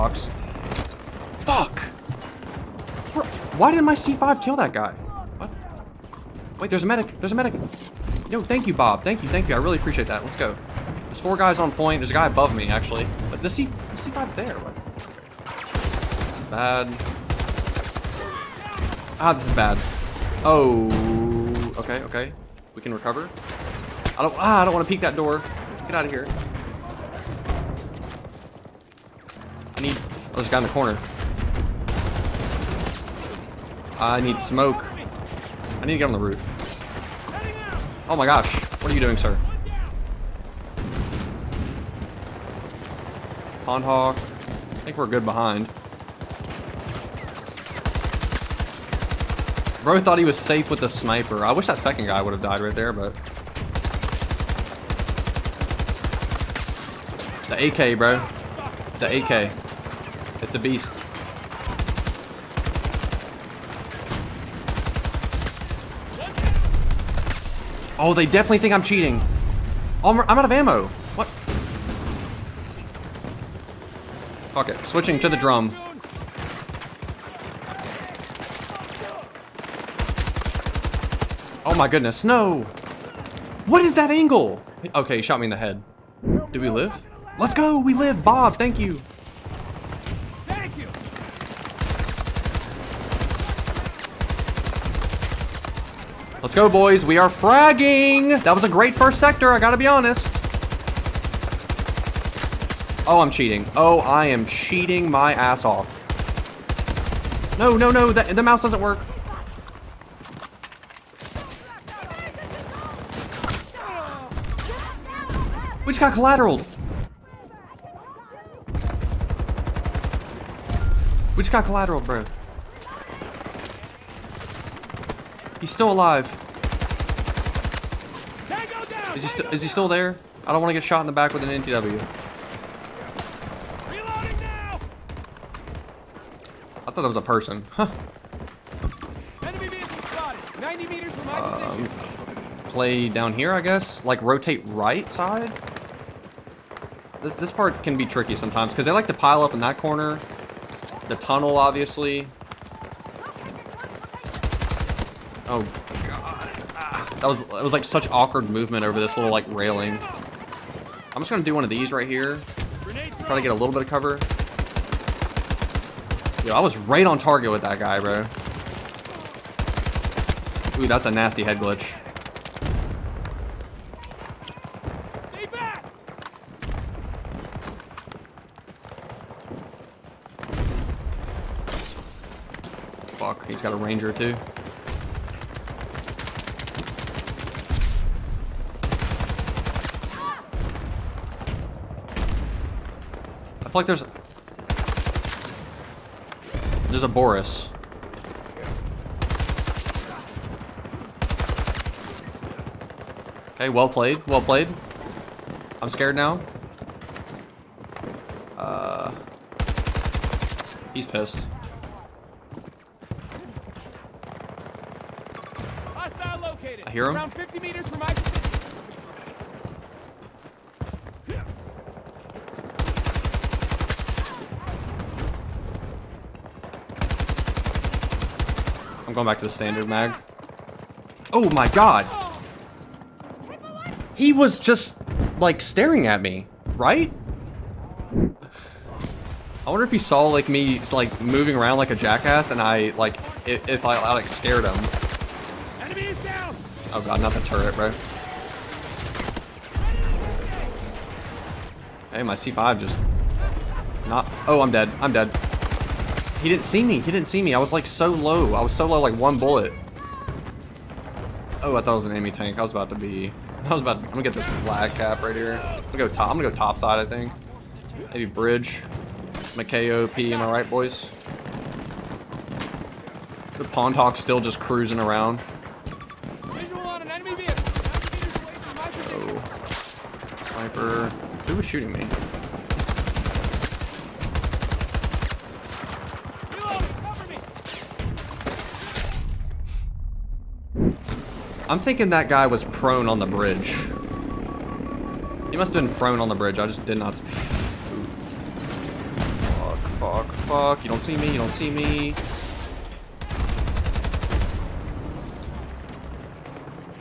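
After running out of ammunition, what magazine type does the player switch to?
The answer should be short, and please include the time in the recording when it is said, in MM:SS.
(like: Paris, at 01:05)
Drum, at 01:14.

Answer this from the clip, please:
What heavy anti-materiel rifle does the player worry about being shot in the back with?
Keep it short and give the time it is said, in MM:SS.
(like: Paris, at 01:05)
NTW, at 02:11.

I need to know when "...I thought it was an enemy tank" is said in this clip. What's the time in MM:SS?
04:21.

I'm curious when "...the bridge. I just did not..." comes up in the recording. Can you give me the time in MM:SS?
04:56.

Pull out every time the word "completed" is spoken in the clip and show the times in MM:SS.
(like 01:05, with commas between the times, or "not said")
not said.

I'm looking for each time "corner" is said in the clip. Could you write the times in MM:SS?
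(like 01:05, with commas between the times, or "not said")
00:30, 02:29.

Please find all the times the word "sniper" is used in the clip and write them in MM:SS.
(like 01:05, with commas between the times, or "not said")
00:50, 04:40.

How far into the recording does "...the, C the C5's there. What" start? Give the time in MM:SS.
00:13.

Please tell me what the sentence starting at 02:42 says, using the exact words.
Try to get a little bit of cover.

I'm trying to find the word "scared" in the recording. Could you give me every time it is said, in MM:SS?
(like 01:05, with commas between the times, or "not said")
03:25, 04:04.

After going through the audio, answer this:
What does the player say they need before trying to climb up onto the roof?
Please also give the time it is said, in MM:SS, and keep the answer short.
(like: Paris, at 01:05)
Smoke, at 00:33.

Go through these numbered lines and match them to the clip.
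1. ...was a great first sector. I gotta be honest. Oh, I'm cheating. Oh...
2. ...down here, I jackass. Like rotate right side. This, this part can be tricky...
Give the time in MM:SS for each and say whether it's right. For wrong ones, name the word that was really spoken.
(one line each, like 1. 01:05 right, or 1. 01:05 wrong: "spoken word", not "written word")
1. 01:38 right
2. 02:23 wrong: "guess", not "jackass".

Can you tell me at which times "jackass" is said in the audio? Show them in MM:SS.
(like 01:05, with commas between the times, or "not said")
04:01.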